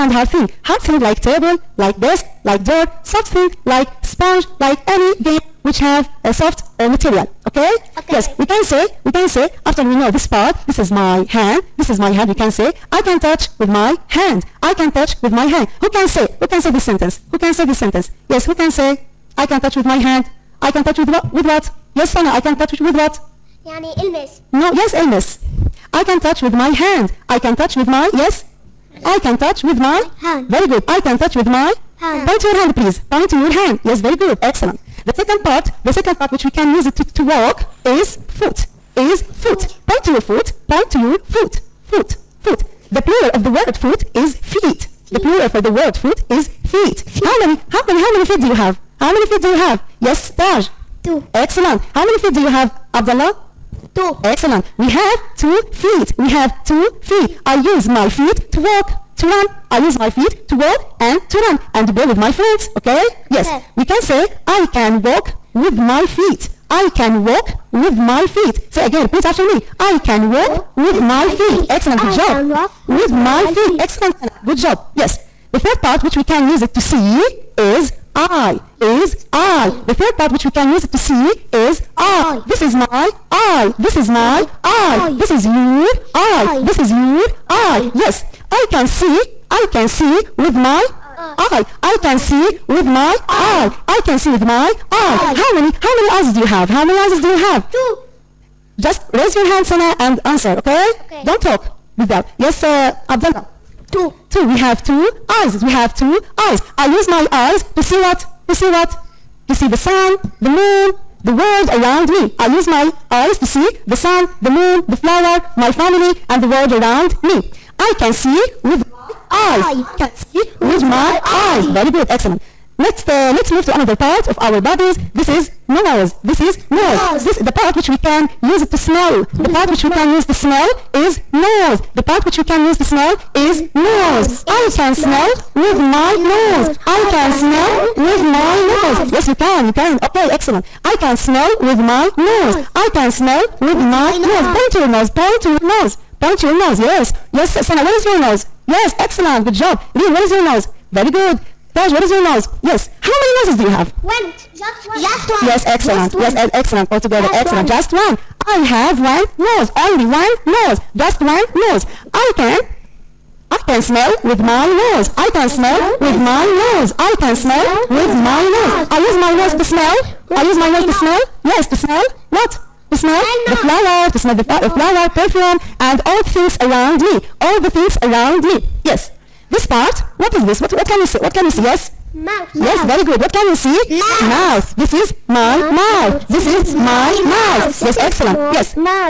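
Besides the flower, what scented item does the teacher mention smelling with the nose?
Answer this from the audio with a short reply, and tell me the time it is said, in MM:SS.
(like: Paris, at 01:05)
perfume, at 02:55.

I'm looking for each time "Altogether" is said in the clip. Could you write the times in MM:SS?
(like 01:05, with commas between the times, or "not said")
02:36.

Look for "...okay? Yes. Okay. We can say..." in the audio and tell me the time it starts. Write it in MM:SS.
01:02.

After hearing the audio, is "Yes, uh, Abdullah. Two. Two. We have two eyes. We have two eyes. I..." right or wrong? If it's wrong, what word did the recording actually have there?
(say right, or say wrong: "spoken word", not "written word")
right.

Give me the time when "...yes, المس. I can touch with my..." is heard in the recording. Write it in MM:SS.
00:24.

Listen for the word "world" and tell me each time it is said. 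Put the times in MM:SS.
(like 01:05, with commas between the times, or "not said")
01:51, 01:56.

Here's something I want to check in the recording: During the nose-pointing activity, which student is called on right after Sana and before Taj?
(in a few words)
Lean.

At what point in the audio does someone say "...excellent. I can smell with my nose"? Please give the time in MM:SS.
02:20.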